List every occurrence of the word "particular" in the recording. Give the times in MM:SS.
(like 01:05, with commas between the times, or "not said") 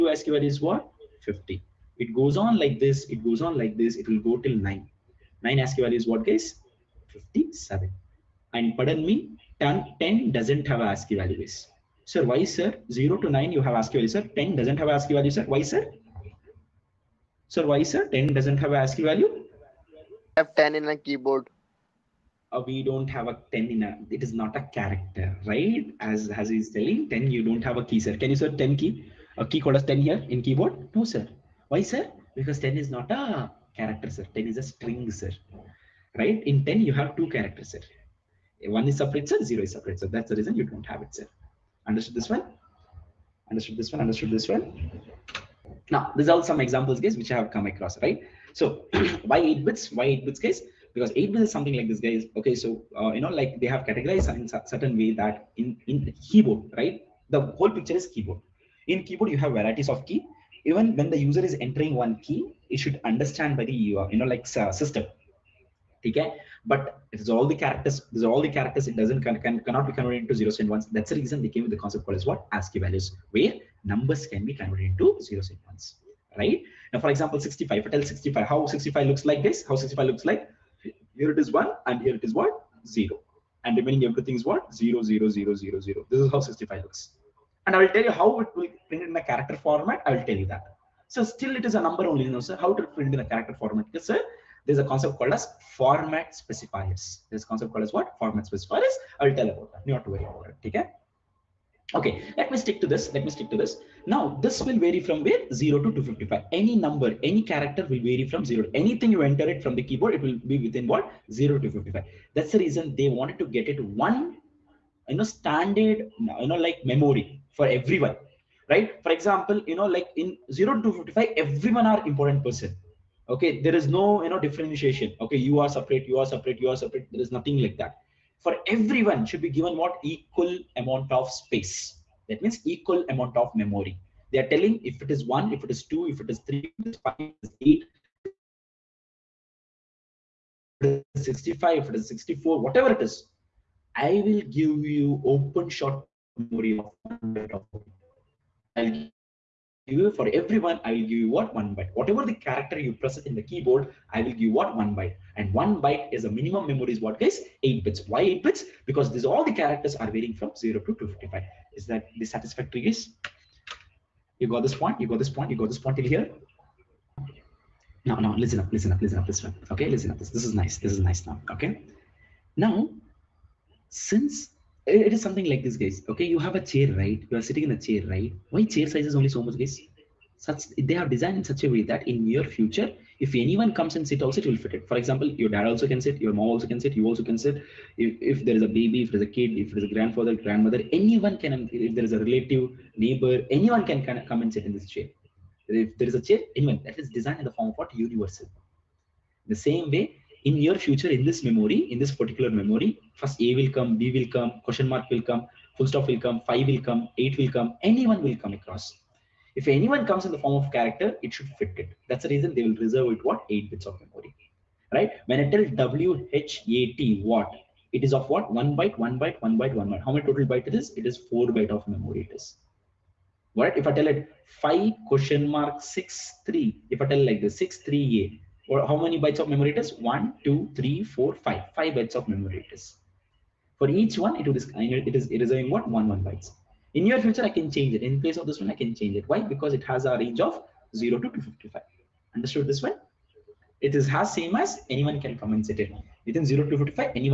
03:22.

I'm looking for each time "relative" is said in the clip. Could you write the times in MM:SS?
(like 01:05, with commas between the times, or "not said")
03:12.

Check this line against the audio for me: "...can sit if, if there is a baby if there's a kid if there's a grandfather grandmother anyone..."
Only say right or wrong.
right.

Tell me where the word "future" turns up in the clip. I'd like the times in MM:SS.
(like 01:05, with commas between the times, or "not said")
03:02, 03:20, 03:57.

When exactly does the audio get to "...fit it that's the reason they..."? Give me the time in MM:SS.
03:31.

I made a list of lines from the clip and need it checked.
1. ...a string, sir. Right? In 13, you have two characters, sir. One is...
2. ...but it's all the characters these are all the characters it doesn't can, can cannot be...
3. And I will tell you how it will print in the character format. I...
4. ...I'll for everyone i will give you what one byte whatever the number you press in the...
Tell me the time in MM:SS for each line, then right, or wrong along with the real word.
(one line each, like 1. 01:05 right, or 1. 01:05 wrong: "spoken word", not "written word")
1. 00:34 wrong: "10", not "13"
2. 01:06 right
3. 01:27 right
4. 02:28 wrong: "character", not "number".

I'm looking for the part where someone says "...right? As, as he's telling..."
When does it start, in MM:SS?
00:25.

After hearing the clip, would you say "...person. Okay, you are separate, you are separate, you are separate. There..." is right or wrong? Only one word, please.
wrong.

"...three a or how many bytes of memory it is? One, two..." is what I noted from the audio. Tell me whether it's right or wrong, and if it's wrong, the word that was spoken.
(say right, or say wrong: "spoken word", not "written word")
right.